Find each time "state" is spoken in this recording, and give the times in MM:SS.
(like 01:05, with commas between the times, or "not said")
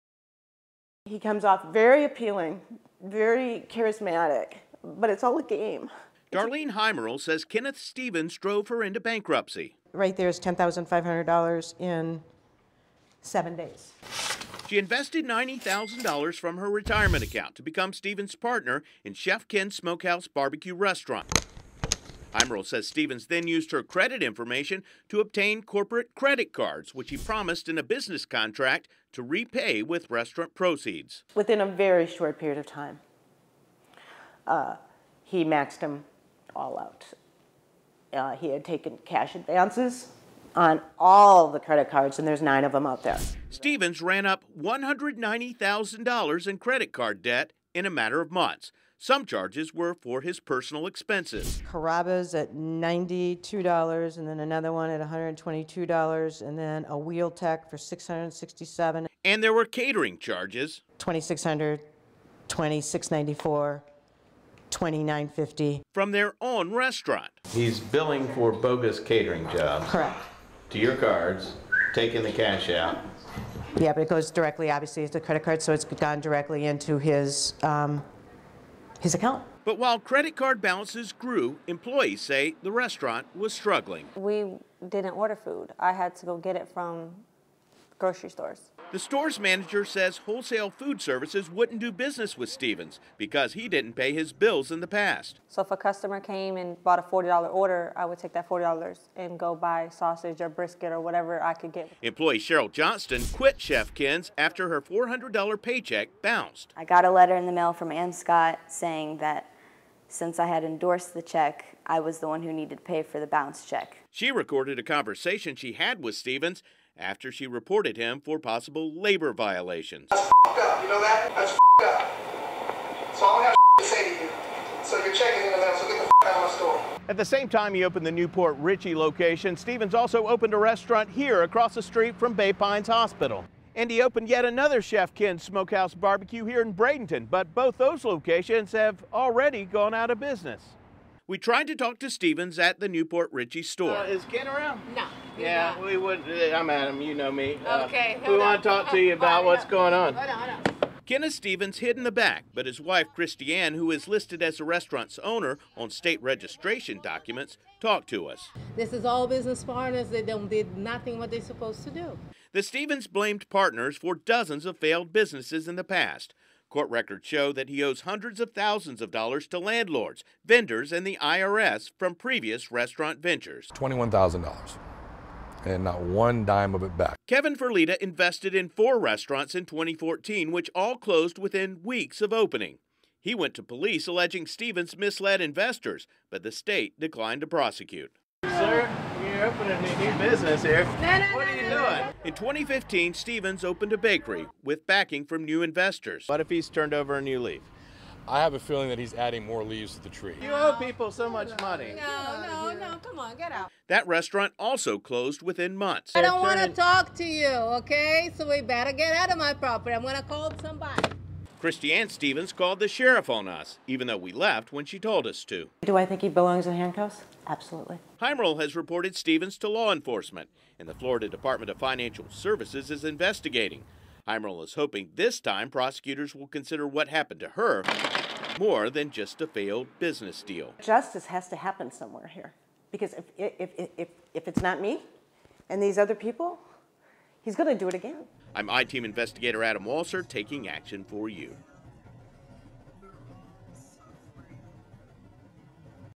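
02:35, 03:06.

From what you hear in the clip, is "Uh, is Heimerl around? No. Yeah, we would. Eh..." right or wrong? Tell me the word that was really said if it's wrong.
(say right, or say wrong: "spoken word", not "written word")
wrong: "Ken", not "Heimerl".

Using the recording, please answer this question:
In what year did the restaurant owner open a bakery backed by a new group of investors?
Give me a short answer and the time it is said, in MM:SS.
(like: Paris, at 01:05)
2015, at 03:12.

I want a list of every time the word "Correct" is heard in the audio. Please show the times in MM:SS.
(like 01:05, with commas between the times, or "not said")
01:09.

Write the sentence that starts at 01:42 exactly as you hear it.
Employee Cheryl Johnston quit Chef Ken's after her $400 paycheck bounced.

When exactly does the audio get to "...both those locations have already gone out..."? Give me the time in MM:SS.
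02:17.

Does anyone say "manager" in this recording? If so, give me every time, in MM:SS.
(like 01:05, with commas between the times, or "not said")
01:29.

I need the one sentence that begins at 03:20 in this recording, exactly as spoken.
You owe people so much money.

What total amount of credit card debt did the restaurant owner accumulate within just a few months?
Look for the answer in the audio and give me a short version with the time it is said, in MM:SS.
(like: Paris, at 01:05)
$190,000, at 00:44.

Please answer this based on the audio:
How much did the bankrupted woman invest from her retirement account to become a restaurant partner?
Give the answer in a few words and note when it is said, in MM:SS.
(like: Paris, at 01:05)
$90,000, at 00:15.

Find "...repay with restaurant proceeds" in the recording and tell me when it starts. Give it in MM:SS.
00:29.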